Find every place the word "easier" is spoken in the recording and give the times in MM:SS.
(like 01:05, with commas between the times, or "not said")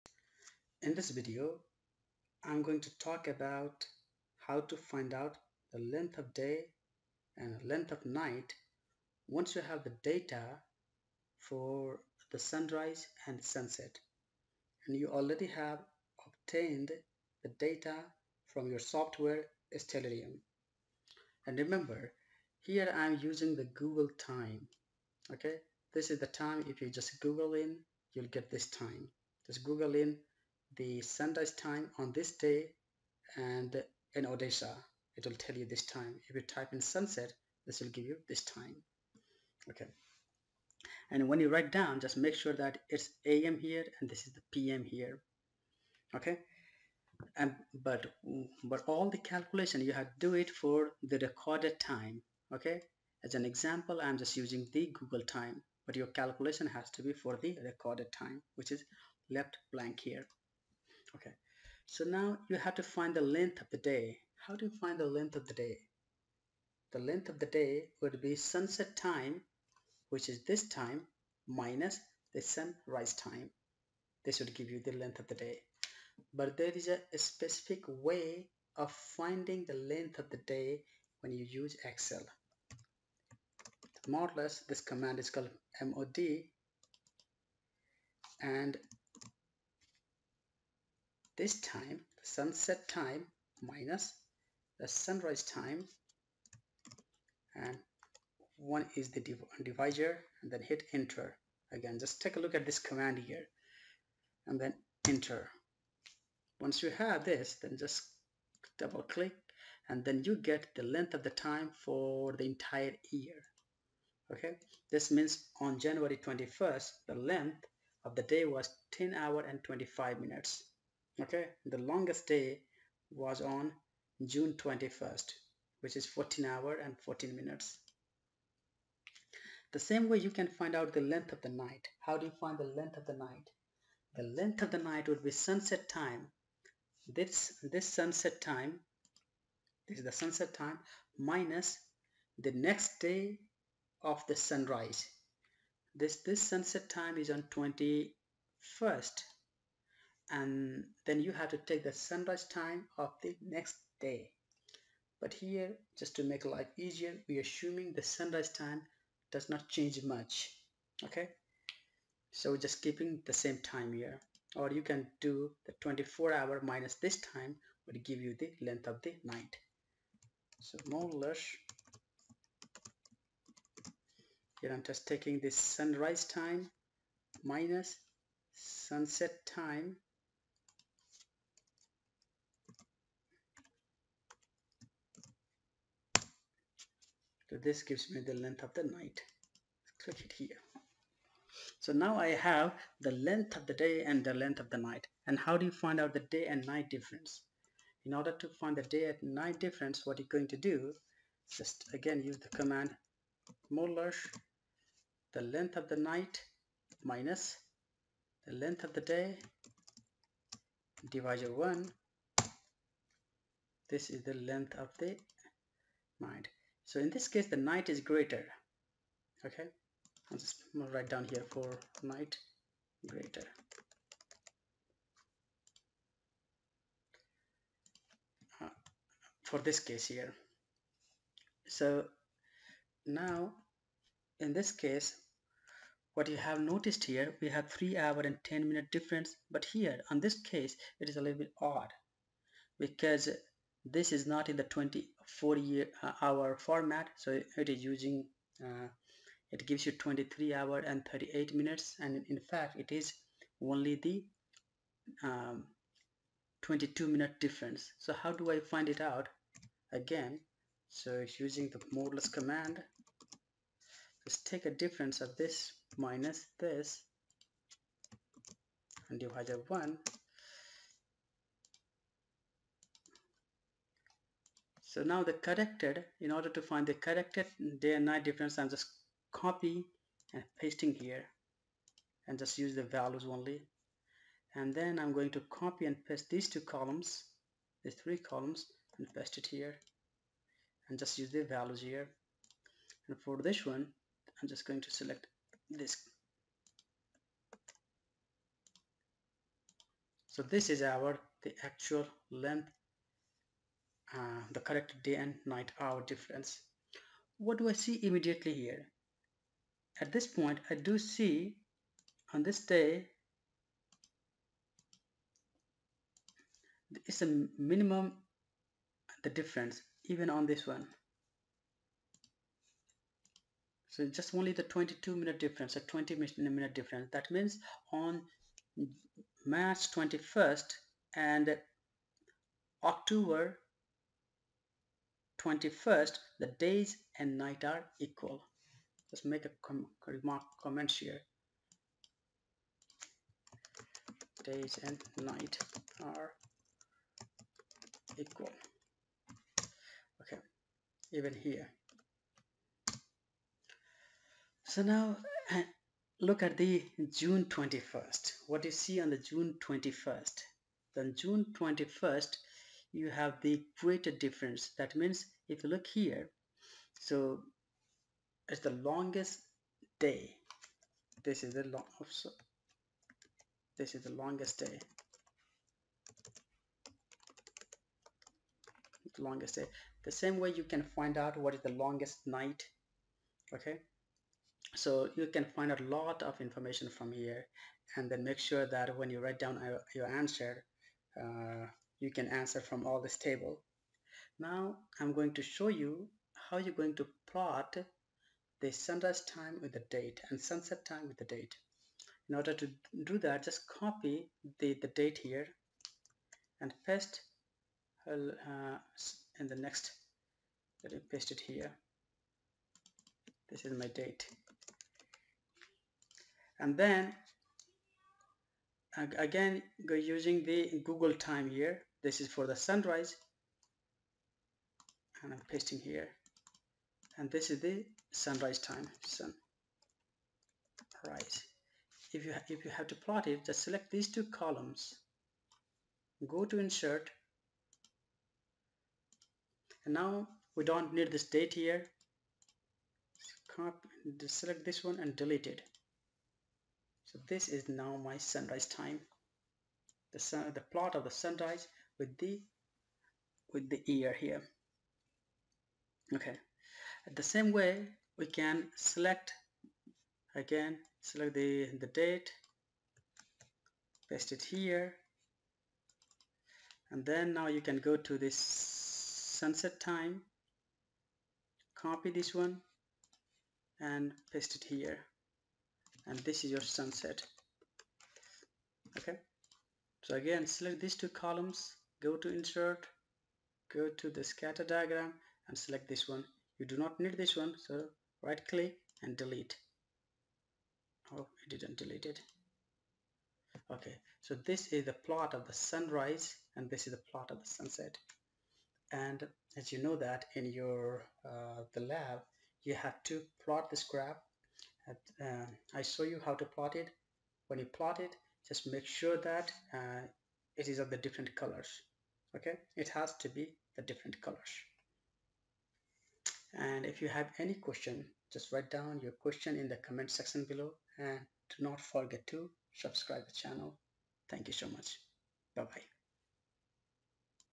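02:36.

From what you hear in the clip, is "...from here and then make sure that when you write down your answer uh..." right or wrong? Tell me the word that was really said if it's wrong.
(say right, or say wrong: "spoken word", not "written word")
right.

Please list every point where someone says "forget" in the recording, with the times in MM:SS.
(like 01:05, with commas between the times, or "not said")
08:41.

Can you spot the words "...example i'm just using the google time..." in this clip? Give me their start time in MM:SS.
00:53.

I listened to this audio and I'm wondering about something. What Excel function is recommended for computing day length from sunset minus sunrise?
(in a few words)
MOD.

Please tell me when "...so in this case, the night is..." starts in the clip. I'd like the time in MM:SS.
03:36.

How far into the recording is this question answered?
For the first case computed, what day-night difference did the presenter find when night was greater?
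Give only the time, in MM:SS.
03:57.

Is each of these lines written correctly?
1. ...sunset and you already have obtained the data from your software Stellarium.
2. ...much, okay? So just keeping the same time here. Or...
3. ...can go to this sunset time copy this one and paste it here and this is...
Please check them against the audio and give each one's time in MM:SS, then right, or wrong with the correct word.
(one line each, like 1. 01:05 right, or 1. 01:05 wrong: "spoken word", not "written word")
1. 00:13 right
2. 02:40 right
3. 07:47 right.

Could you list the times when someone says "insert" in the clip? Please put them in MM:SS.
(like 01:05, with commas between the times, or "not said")
07:16, 08:02.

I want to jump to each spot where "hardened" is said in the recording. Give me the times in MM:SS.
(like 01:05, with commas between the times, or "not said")
not said.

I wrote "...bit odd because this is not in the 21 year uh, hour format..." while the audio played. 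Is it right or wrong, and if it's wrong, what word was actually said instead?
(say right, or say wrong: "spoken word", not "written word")
wrong: "24", not "21".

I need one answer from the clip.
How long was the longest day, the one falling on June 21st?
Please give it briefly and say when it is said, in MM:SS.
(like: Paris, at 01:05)
14 hours 14 minutes, at 02:06.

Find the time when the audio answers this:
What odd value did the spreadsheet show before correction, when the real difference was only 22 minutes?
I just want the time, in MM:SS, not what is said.
04:09.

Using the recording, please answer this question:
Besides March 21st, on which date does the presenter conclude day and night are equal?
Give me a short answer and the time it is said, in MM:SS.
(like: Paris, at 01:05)
October 21st, at 05:32.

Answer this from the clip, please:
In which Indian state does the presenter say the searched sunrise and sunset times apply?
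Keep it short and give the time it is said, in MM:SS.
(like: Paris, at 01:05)
Odisha, at 00:34.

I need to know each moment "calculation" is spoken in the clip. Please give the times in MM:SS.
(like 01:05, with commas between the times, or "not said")
00:49, 00:56.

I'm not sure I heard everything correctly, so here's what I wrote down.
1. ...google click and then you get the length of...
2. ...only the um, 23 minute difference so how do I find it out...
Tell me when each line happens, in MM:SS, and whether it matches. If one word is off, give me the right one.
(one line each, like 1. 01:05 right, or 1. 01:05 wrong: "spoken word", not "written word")
1. 01:48 wrong: "double", not "google"
2. 04:13 wrong: "22", not "23".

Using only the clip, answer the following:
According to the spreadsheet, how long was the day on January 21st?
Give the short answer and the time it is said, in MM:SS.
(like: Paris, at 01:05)
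10 hours 25 minutes, at 01:58.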